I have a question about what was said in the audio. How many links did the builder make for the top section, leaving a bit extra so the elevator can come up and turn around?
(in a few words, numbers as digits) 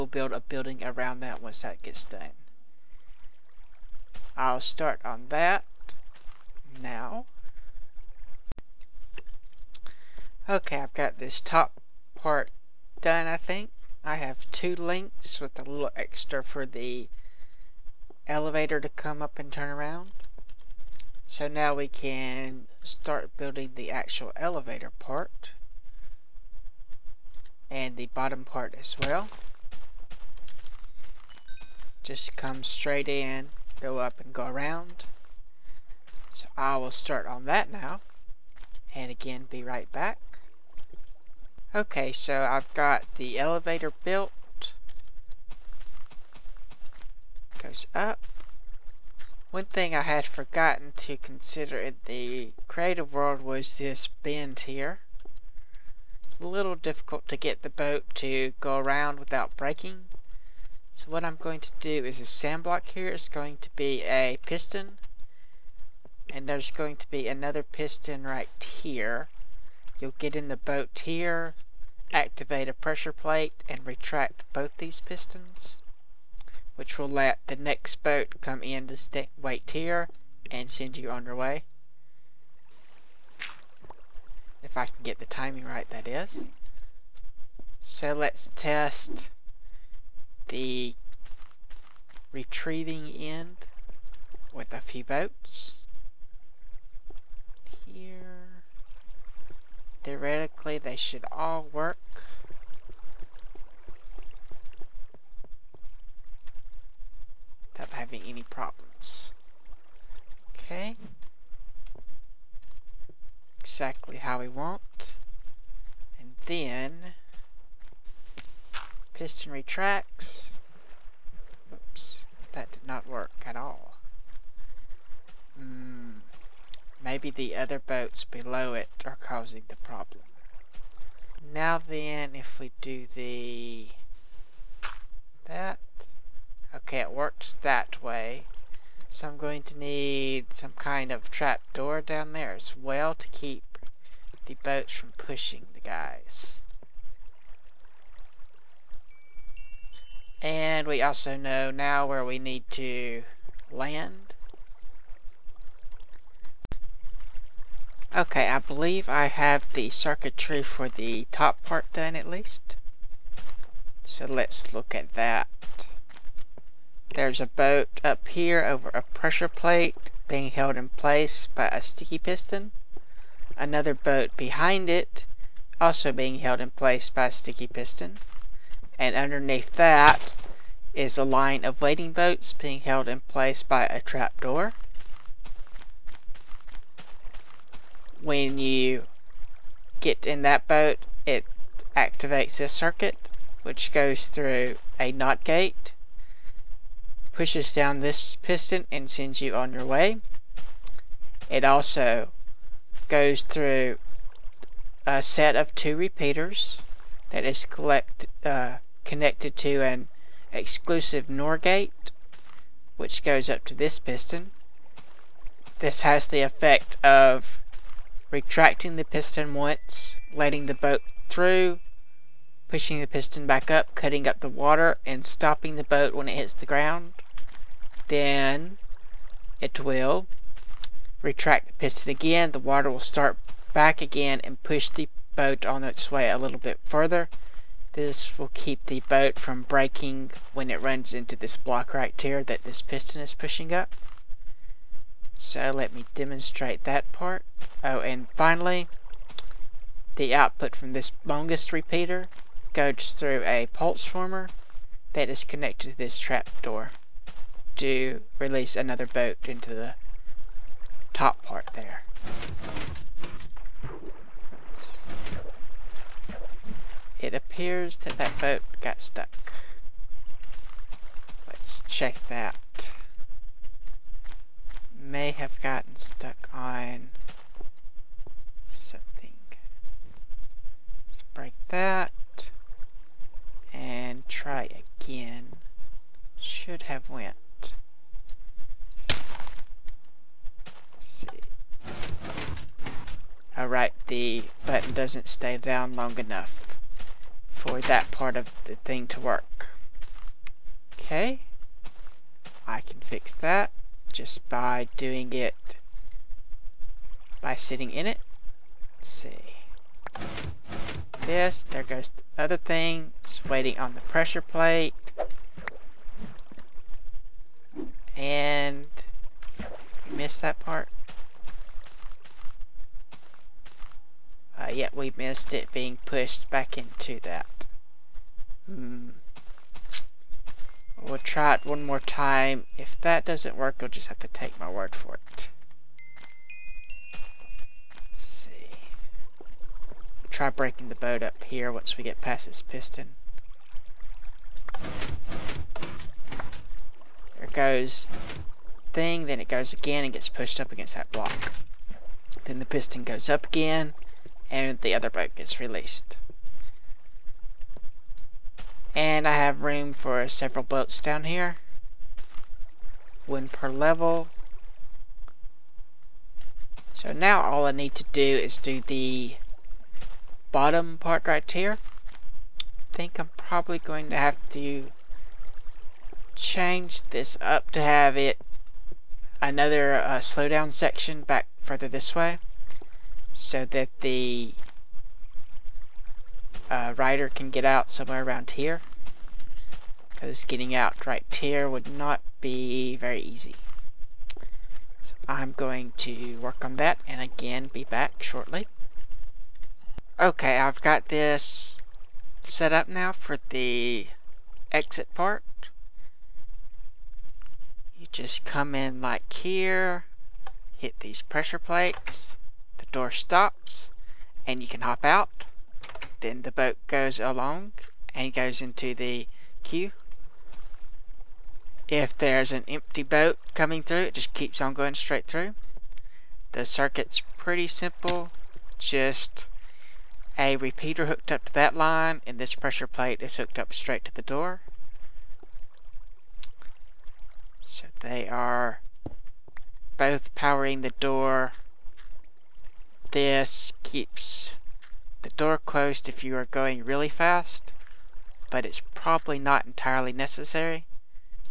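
2.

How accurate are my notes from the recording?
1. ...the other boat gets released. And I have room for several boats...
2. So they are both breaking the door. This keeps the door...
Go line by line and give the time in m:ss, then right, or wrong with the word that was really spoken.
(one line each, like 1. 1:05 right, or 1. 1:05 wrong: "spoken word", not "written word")
1. 5:54 right
2. 7:17 wrong: "powering", not "breaking".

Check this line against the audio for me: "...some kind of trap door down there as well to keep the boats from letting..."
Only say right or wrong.
wrong.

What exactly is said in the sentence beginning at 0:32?
Just come straight in, go up and go around.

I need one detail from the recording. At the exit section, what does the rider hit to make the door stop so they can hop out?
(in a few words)
Pressure plates.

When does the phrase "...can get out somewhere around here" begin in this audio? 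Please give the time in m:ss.
6:27.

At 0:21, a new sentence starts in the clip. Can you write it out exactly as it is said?
So now we can start building the actual elevator part and the bottom part as well.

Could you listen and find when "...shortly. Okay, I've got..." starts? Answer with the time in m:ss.
6:38.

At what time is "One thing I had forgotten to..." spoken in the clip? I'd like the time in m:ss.
0:49.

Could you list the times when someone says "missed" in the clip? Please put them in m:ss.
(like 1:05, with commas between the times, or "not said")
5:20, 5:25.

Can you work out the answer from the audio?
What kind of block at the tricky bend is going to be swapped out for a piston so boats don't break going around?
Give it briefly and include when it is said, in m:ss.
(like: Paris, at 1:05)
Sand block, at 1:02.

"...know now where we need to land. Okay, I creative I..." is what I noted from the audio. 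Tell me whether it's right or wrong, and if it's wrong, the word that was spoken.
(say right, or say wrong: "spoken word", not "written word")
wrong: "believe", not "creative".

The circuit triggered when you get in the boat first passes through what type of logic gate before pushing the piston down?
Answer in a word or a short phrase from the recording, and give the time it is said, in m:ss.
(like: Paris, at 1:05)
NOT gate, at 3:15.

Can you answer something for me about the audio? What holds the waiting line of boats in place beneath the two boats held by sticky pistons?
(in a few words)
A trapdoor.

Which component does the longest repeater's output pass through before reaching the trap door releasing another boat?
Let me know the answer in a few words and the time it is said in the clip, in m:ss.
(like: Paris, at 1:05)
Pulse former, at 4:13.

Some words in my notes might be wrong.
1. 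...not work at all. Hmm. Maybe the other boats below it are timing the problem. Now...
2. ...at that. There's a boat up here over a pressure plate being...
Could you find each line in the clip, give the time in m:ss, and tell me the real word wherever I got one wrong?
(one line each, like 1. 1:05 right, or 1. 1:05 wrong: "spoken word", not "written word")
1. 2:02 wrong: "causing", not "timing"
2. 2:44 right.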